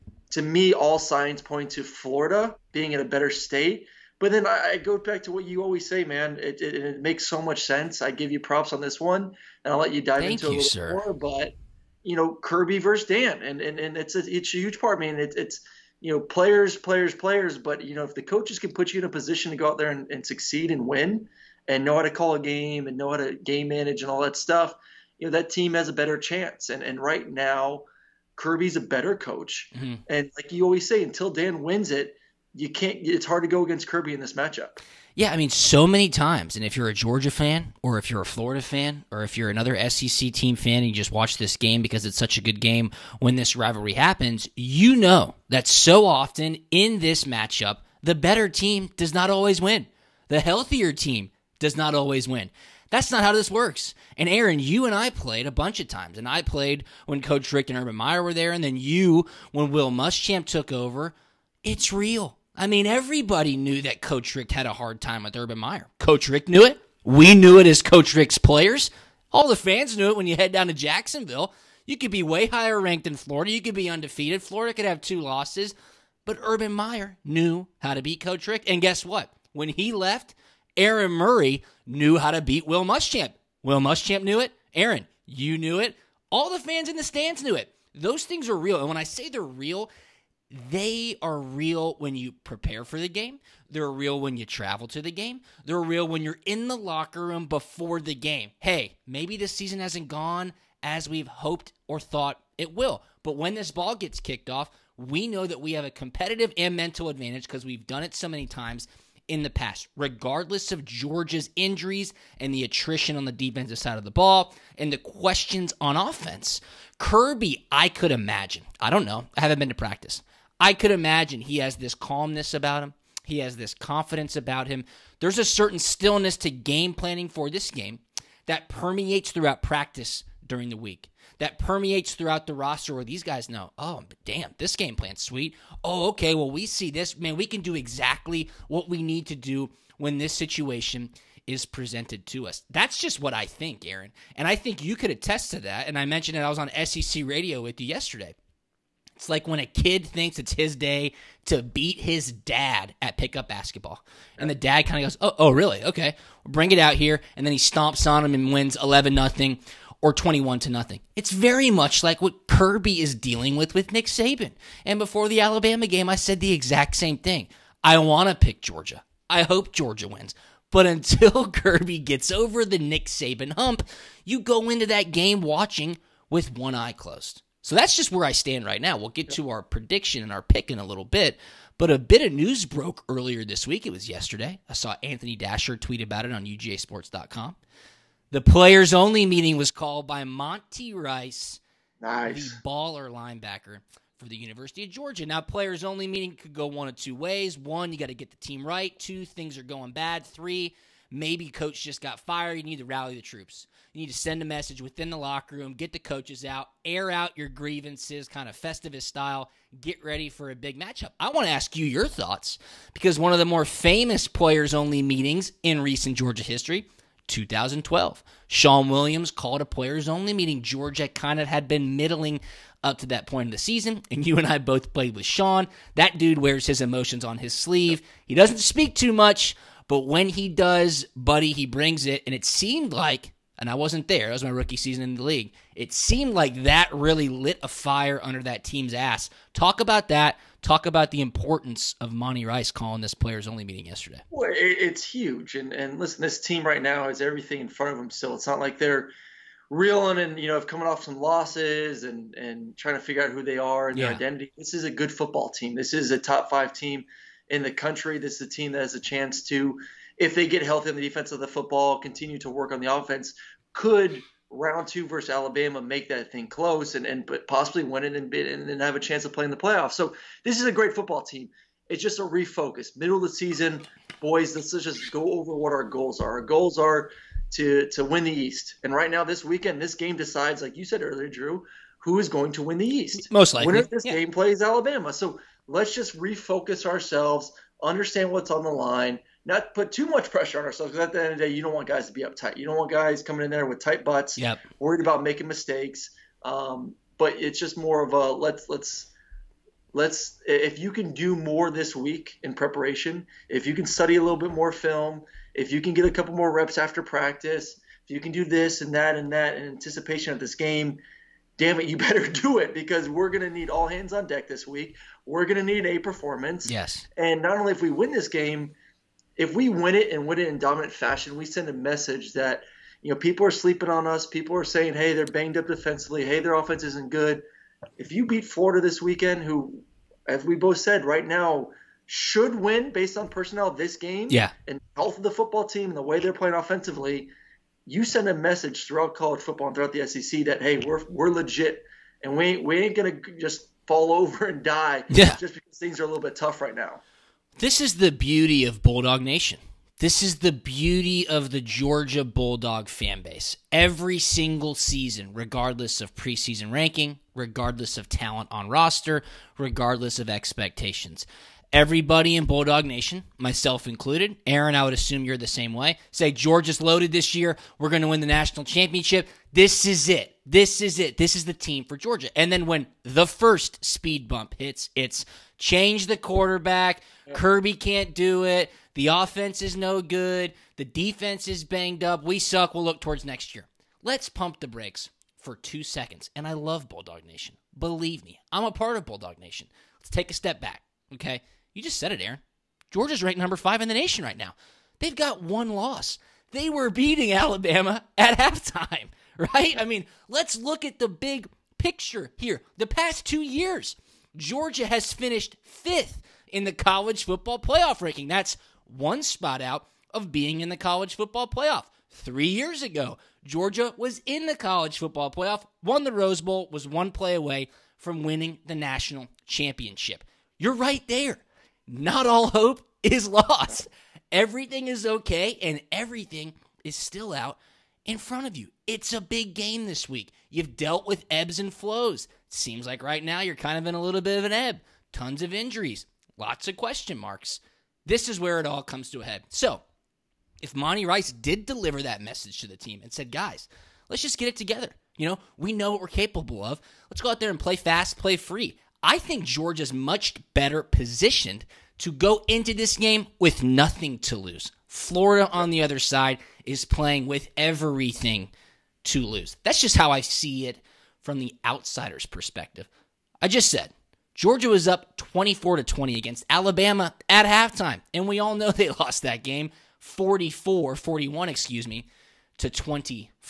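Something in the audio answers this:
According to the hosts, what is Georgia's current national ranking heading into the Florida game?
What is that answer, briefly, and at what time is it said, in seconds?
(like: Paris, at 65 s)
5, at 393 s.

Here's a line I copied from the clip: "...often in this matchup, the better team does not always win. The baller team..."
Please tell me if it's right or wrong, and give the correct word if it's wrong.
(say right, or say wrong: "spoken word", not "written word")
wrong: "healthier", not "baller".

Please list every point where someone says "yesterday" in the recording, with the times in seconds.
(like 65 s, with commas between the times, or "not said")
147 s, 184 s, 243 s.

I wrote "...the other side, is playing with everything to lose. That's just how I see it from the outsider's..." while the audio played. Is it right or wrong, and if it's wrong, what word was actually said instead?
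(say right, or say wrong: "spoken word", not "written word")
right.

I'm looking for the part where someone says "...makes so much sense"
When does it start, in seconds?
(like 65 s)
7 s.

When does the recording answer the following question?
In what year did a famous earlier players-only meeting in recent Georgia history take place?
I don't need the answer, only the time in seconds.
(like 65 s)
217 s.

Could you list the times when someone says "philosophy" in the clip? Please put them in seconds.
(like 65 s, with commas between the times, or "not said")
not said.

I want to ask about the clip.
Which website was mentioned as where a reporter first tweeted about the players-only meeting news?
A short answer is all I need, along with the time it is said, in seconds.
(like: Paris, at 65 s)
UGAsports.com, at 186 s.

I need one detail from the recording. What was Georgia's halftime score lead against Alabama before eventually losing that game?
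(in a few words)
24 to 20.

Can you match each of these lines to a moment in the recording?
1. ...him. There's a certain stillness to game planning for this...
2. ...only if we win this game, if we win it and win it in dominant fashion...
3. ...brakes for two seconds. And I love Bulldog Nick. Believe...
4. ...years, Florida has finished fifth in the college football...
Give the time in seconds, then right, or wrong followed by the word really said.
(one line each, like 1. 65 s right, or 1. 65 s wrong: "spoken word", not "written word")
1. 124 s right
2. 317 s right
3. 384 s wrong: "Nation", not "Nick"
4. 403 s wrong: "Georgia", not "Florida".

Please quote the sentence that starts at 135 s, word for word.
Oh, okay, well, we see this.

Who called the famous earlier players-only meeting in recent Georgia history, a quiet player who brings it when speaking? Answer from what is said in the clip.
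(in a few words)
Shawn Williams.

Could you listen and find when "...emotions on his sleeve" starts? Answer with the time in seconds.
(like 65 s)
226 s.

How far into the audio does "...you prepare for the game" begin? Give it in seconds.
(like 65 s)
92 s.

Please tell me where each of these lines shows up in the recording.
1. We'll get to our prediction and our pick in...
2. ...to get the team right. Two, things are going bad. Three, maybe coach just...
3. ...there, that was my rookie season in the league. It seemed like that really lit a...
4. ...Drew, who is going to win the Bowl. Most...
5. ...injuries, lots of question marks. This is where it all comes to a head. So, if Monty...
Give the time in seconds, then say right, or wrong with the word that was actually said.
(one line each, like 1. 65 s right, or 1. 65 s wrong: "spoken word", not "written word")
1. 178 s right
2. 198 s right
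3. 234 s right
4. 281 s wrong: "East", not "Bowl"
5. 435 s right.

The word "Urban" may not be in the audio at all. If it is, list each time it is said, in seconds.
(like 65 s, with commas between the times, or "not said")
57 s, 65 s, 76 s.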